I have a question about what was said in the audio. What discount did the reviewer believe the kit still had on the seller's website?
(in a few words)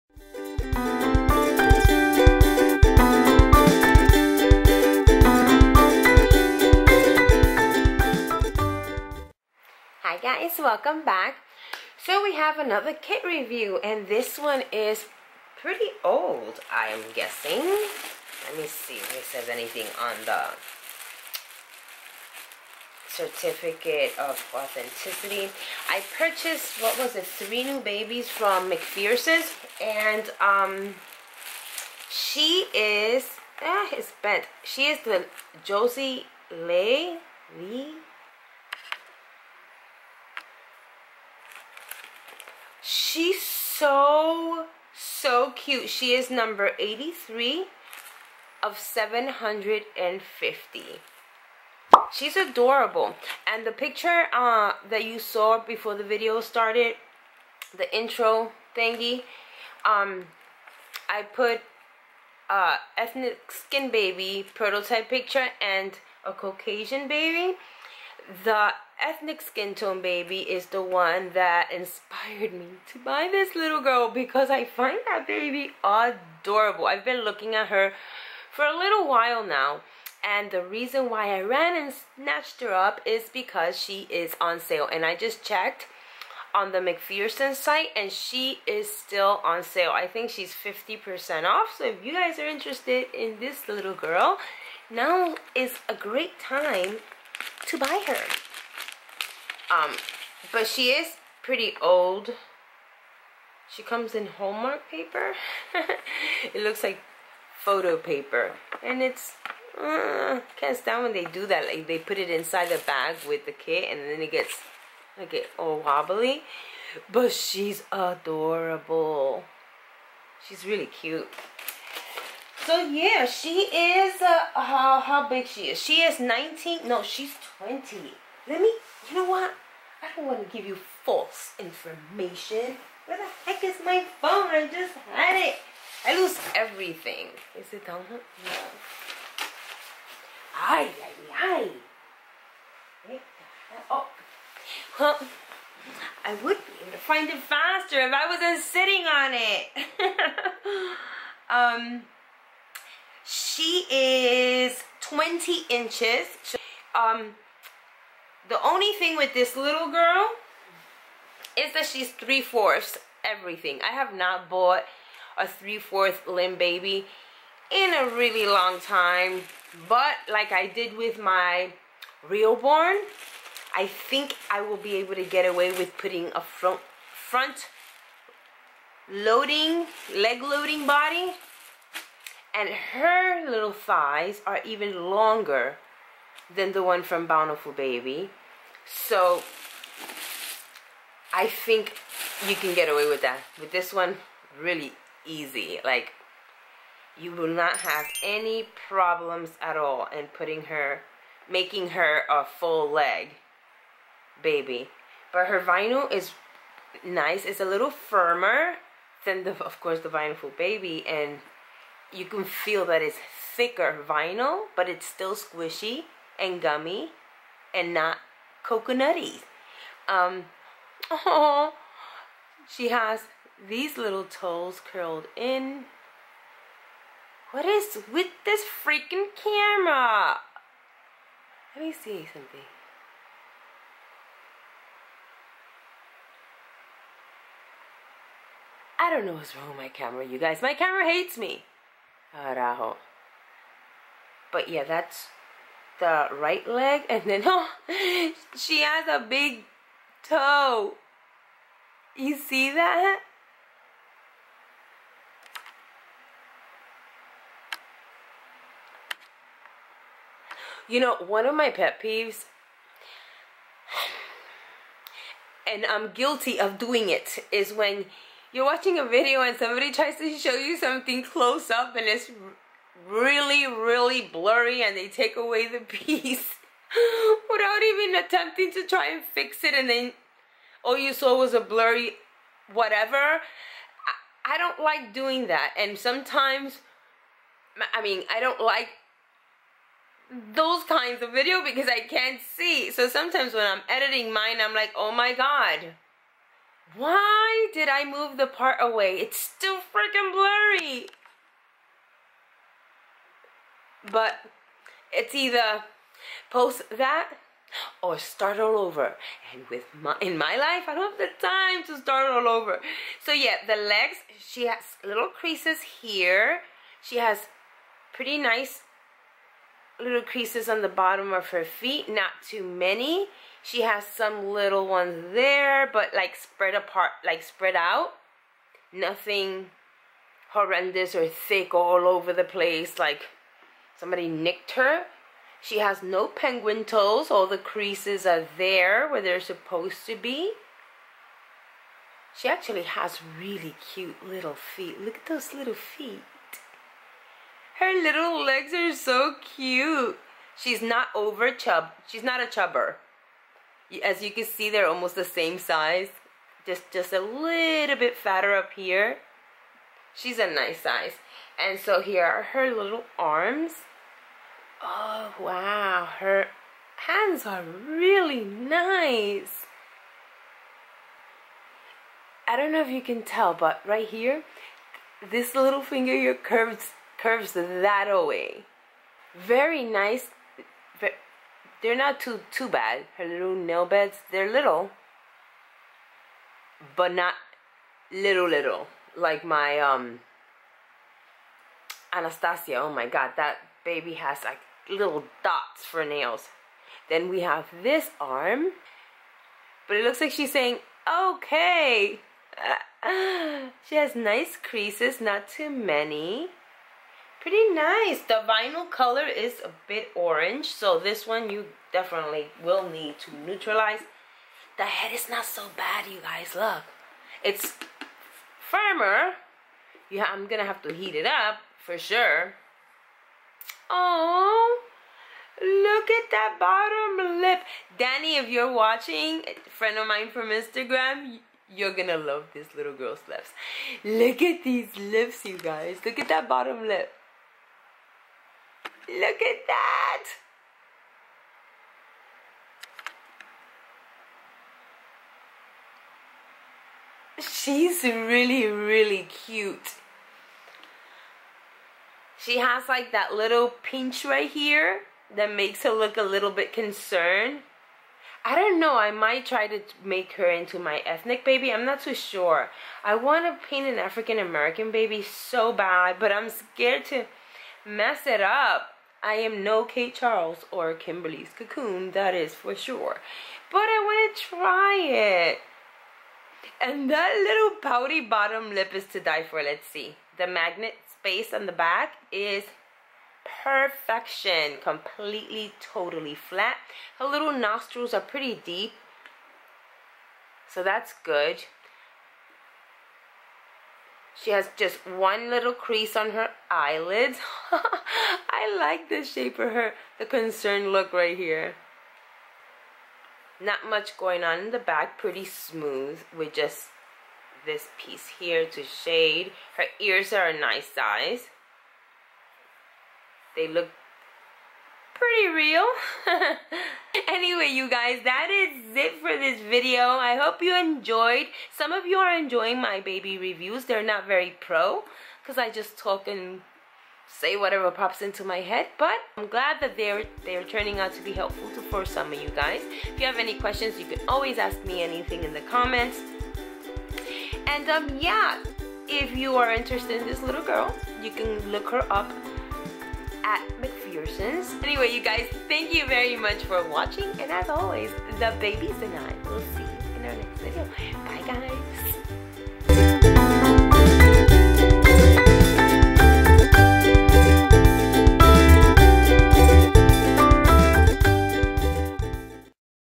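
50%.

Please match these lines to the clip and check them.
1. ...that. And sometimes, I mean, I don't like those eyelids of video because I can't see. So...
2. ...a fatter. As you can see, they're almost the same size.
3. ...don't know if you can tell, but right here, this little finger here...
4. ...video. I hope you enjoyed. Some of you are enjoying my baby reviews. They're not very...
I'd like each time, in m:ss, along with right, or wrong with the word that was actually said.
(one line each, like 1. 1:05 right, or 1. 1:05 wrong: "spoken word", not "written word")
1. 4:45 wrong: "kinds", not "eyelids"
2. 5:52 wrong: "chubber", not "fatter"
3. 6:12 right
4. 8:39 right.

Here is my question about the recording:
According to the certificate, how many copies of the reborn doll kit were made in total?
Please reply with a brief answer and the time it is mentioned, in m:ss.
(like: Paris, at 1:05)
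750, at 0:48.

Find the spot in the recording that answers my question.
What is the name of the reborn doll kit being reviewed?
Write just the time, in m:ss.
0:35.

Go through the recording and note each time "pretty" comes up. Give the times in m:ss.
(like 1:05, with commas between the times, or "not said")
0:15, 1:41, 5:18, 6:47, 8:08, 8:25, 8:35.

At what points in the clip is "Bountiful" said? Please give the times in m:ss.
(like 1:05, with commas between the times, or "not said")
3:07, 3:30.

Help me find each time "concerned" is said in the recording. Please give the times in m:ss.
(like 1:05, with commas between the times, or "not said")
7:36, 8:20.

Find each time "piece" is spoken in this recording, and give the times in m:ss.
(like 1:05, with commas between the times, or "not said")
4:35, 8:28.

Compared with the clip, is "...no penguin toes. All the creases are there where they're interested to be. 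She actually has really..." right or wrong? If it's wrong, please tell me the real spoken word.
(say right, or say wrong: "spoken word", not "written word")
wrong: "supposed", not "interested".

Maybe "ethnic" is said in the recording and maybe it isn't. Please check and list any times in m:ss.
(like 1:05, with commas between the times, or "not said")
1:02, 1:09, 7:41.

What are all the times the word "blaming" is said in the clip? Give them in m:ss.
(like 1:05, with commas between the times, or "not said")
not said.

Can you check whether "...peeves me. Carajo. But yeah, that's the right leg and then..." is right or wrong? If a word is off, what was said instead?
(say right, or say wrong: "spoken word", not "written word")
wrong: "hates", not "peeves".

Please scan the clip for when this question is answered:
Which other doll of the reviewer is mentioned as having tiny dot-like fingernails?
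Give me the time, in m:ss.
6:32.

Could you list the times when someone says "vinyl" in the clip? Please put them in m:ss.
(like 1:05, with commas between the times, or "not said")
3:25, 3:34, 6:48.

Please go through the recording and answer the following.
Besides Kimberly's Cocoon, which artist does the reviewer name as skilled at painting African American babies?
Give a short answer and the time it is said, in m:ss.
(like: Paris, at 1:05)
Kate Charles, at 7:49.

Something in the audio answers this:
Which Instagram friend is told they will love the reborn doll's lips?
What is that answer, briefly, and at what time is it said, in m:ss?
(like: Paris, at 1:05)
Danny, at 7:07.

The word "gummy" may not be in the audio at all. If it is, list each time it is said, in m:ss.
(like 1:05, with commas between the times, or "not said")
3:36.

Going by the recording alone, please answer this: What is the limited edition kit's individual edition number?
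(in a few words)
83.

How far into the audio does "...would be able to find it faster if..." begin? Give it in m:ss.
2:26.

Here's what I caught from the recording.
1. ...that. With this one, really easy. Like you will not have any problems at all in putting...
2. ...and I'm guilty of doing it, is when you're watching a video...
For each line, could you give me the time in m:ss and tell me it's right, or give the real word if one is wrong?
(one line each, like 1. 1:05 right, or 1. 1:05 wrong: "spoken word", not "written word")
1. 3:13 right
2. 4:25 right.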